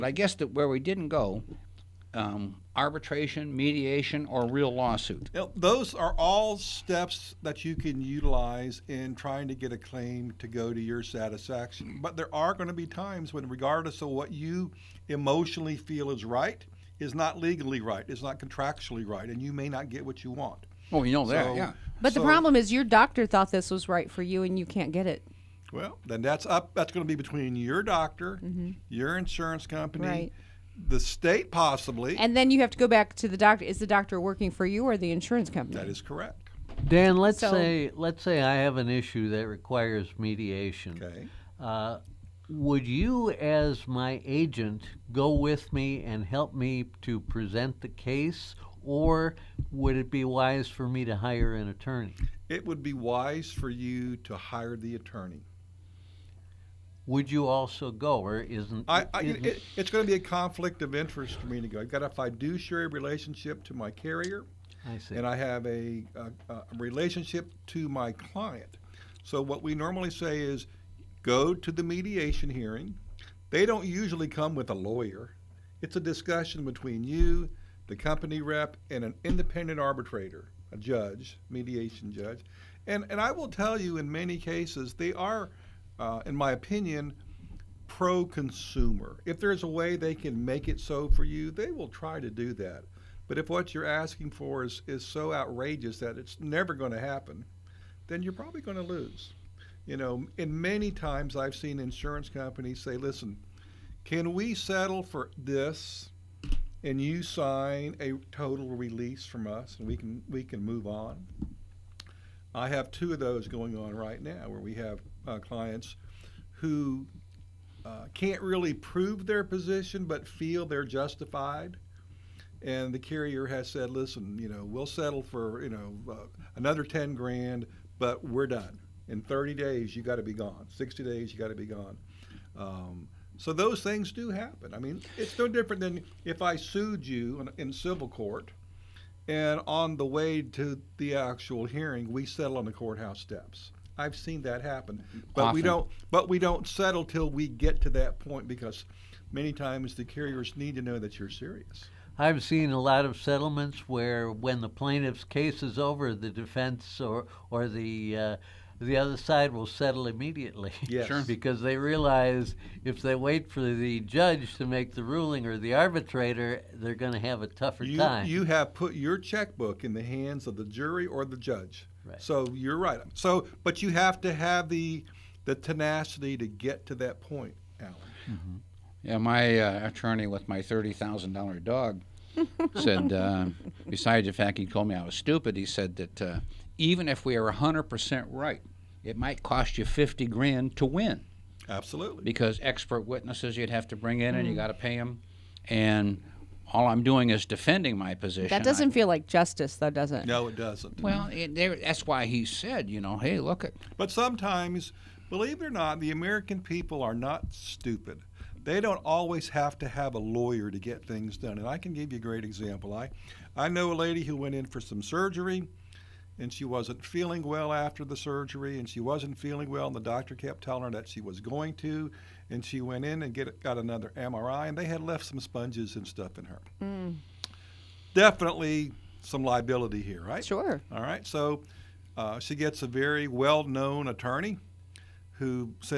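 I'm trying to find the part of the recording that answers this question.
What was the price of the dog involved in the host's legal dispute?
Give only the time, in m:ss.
3:00.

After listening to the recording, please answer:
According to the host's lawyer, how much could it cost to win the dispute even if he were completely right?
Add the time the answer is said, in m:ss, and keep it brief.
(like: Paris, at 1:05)
50 grand, at 3:09.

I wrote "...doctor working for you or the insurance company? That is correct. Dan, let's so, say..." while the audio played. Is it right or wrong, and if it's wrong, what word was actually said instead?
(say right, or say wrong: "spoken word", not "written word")
right.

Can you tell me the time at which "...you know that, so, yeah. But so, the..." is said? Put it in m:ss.
0:21.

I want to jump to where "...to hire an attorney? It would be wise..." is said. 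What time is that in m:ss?
0:51.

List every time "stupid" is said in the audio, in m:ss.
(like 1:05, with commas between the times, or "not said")
3:05, 3:27.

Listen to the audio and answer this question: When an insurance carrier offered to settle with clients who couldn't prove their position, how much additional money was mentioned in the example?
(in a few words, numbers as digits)
10 grand.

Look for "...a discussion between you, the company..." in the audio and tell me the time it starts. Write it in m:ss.
1:15.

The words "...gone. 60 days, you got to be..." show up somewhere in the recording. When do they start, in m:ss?
2:10.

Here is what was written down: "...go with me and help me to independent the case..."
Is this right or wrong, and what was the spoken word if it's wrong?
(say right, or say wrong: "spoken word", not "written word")
wrong: "present", not "independent".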